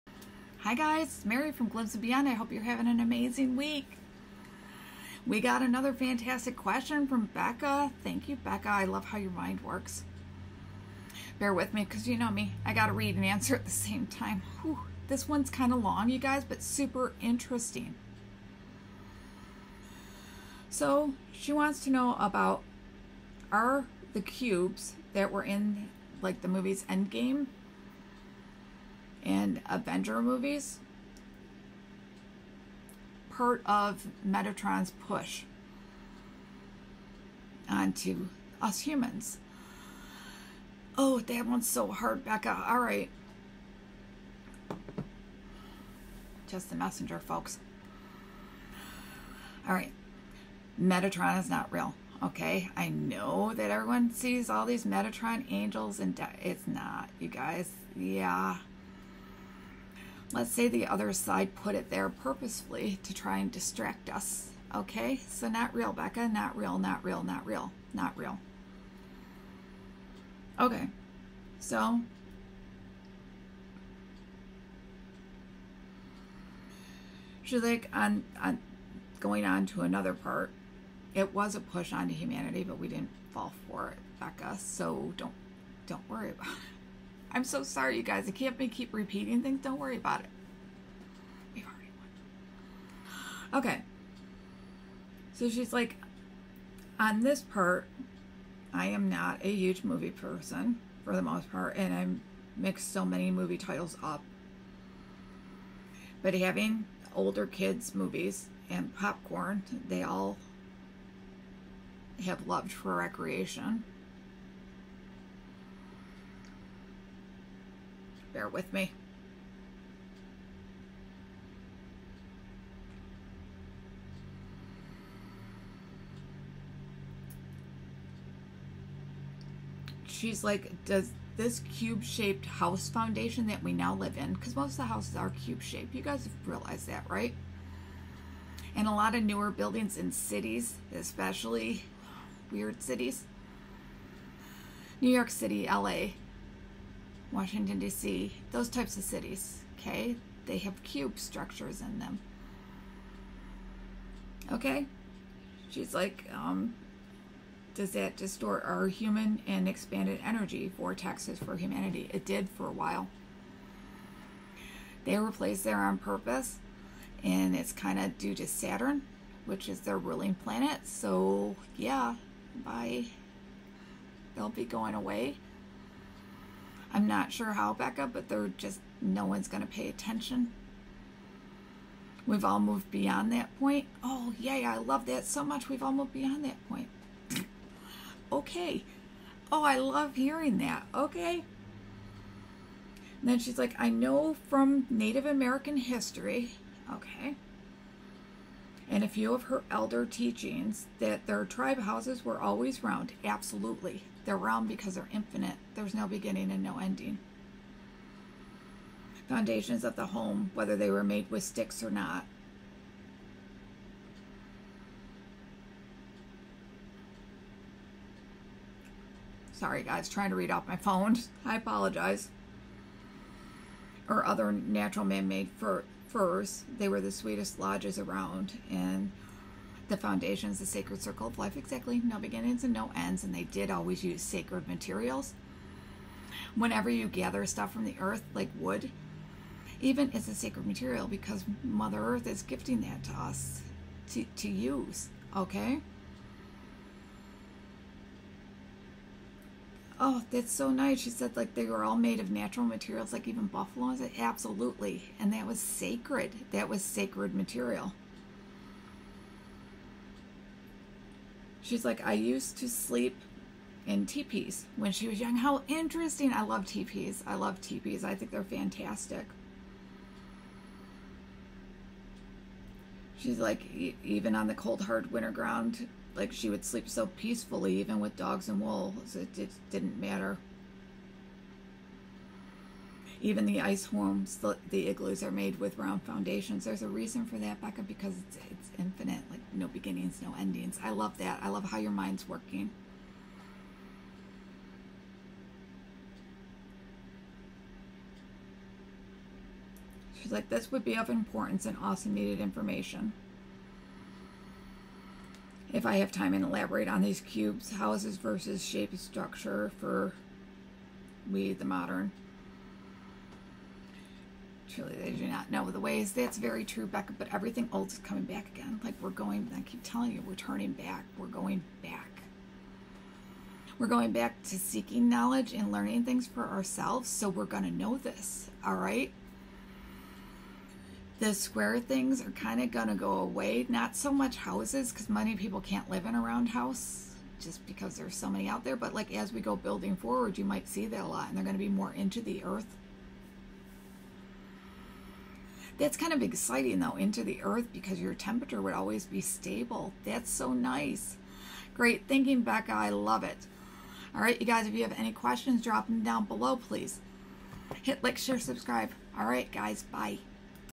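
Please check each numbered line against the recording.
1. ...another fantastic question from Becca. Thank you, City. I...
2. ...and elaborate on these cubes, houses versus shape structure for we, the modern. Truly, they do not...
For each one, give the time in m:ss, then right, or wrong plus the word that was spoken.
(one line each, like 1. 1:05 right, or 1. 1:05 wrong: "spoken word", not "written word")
1. 0:05 wrong: "Becca", not "City"
2. 5:06 right.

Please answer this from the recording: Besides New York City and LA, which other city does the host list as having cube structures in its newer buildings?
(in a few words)
Washington, D.C.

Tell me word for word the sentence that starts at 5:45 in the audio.
That's kind of exciting though, into the earth because your temperature would always be stable.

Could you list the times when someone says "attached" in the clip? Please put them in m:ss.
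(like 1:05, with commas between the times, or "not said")
not said.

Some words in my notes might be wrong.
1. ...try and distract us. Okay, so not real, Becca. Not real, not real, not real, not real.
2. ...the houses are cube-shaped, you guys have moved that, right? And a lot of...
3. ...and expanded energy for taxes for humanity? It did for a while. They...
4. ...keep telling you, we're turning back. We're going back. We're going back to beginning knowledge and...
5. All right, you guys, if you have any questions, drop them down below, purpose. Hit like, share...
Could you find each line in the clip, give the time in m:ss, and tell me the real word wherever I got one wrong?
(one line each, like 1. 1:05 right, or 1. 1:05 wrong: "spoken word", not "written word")
1. 1:03 right
2. 2:14 wrong: "realized", not "moved"
3. 2:39 right
4. 5:19 wrong: "seeking", not "beginning"
5. 5:54 wrong: "please", not "purpose".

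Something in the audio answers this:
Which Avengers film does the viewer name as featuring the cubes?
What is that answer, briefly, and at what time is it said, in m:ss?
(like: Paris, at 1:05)
Endgame, at 0:26.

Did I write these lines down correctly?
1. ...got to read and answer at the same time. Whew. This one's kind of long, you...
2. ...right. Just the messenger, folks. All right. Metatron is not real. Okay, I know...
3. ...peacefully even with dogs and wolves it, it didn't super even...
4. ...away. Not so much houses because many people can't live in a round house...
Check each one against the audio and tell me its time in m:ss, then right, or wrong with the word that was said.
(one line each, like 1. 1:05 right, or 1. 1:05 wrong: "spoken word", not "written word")
1. 0:12 right
2. 0:42 right
3. 4:37 wrong: "matter", not "super"
4. 5:33 right.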